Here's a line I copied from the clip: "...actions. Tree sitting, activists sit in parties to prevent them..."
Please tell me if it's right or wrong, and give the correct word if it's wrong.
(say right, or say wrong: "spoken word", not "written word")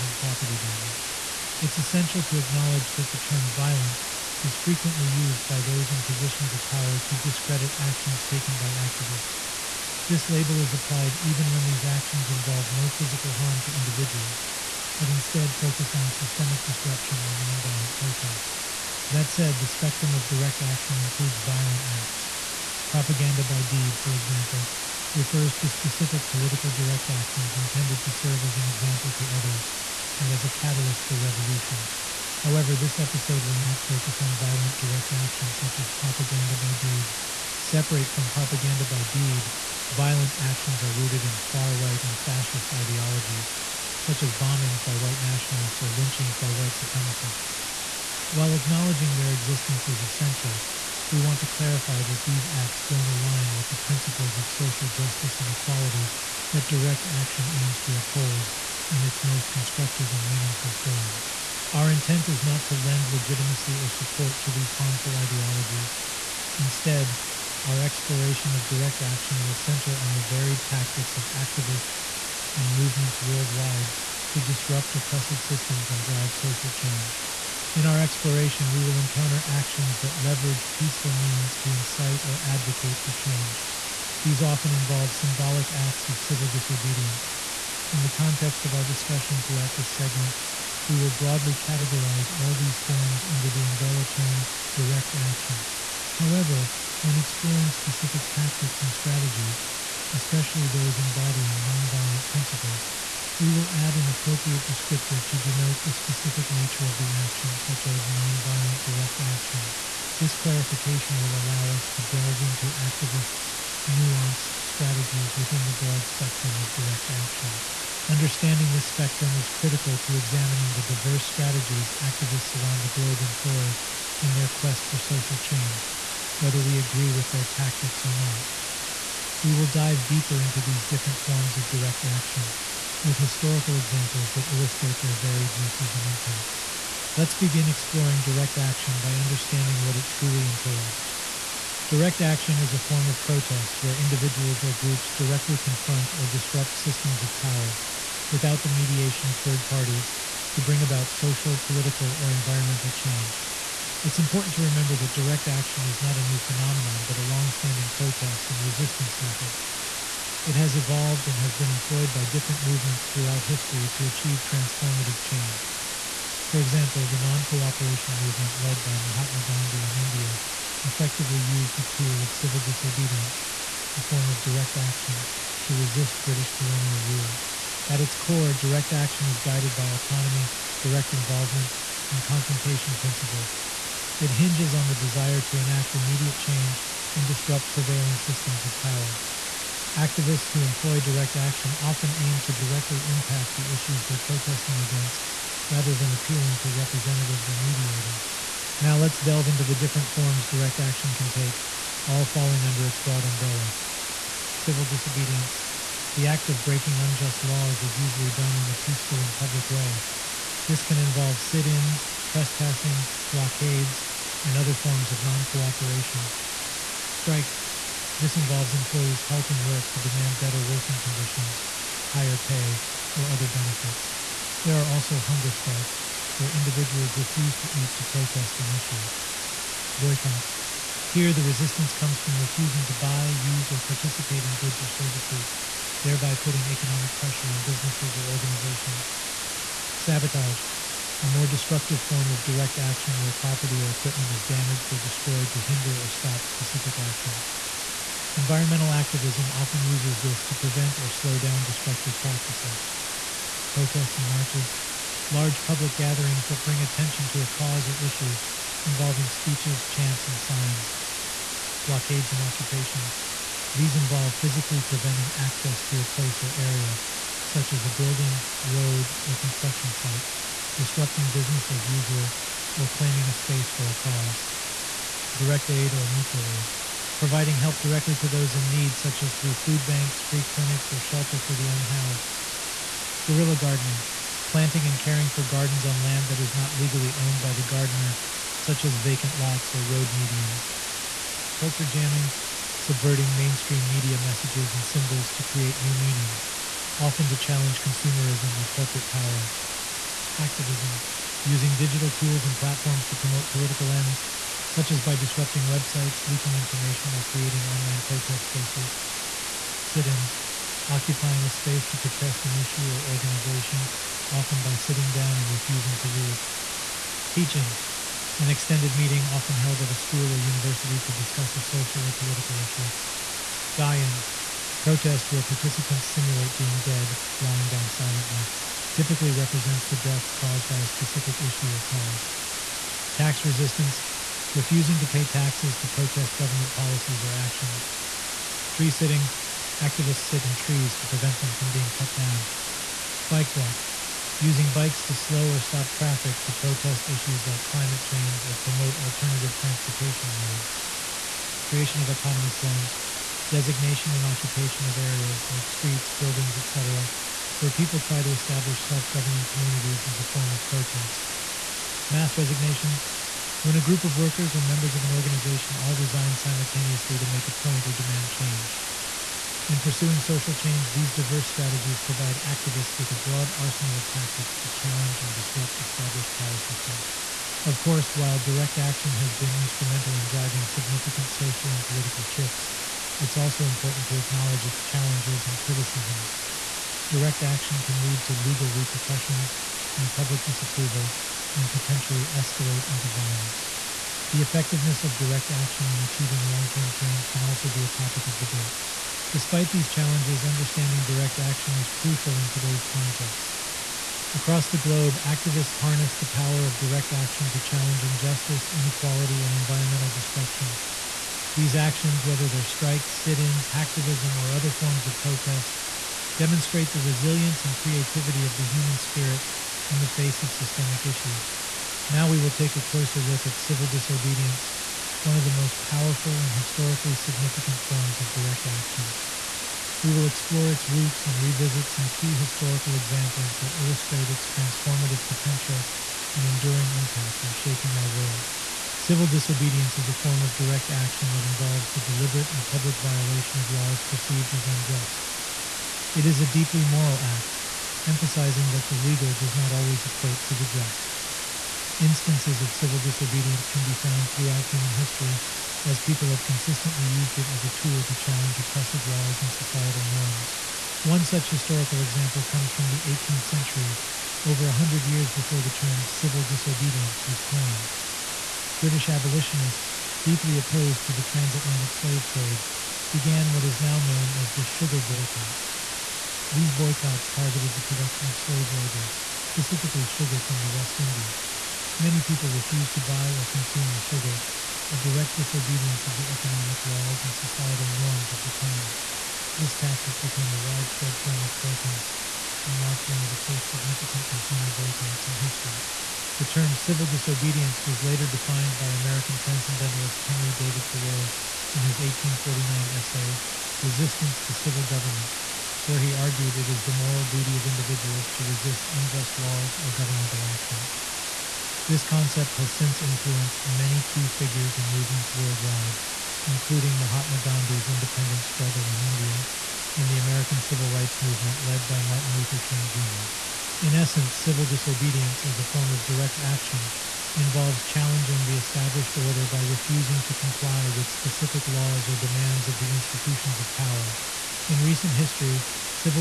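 wrong: "trees", not "parties".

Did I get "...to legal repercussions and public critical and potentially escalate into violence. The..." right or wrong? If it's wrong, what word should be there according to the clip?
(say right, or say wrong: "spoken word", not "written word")
wrong: "disapproval", not "critical".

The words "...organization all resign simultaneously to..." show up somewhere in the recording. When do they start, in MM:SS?
06:05.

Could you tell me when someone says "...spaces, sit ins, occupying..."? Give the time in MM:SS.
05:08.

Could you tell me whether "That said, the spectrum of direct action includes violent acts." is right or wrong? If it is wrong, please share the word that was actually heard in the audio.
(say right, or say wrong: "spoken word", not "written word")
right.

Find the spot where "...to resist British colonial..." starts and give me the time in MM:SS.
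02:55.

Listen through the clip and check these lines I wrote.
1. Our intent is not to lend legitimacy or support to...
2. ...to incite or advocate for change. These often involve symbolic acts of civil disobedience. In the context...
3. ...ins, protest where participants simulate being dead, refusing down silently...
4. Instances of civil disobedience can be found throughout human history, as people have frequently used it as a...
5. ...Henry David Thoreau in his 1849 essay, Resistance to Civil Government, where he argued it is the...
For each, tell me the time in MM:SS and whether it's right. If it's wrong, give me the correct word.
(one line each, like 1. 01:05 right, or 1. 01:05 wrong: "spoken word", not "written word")
1. 01:01 right
2. 01:21 right
3. 05:23 wrong: "lying", not "refusing"
4. 07:31 wrong: "consistently", not "frequently"
5. 08:20 right.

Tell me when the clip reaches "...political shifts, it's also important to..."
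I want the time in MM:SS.
06:21.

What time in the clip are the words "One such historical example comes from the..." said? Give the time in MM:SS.
07:41.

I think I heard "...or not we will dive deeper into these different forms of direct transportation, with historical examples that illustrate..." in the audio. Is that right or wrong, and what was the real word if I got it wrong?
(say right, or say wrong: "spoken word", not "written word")
wrong: "action", not "transportation".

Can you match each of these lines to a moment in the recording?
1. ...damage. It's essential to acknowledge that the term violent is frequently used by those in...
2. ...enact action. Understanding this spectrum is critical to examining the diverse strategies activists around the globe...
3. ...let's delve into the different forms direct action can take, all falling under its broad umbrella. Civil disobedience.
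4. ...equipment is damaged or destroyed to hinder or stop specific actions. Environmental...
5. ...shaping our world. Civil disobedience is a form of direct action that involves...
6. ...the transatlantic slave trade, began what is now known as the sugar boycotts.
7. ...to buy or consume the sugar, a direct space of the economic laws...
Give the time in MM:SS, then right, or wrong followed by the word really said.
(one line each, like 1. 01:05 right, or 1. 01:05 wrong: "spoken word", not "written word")
1. 00:00 right
2. 01:56 wrong: "direct", not "enact"
3. 03:18 right
4. 04:03 right
5. 07:17 right
6. 07:51 right
7. 08:02 wrong: "disobedience", not "space".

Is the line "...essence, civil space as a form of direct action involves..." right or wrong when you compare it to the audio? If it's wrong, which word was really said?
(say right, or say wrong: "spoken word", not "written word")
wrong: "disobedience", not "space".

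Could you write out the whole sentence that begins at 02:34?
It's important to remember that direct action is not a new phenomenon, but a long-standing protest and resistance method.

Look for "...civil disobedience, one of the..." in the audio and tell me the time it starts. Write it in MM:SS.
07:03.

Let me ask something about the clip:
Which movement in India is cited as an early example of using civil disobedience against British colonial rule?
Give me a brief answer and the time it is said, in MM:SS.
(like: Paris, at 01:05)
Non cooperation movement, at 02:47.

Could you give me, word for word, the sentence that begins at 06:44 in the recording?
Across the globe, activists harness the power of direct action to challenge injustice, inequality, and environmental destruction.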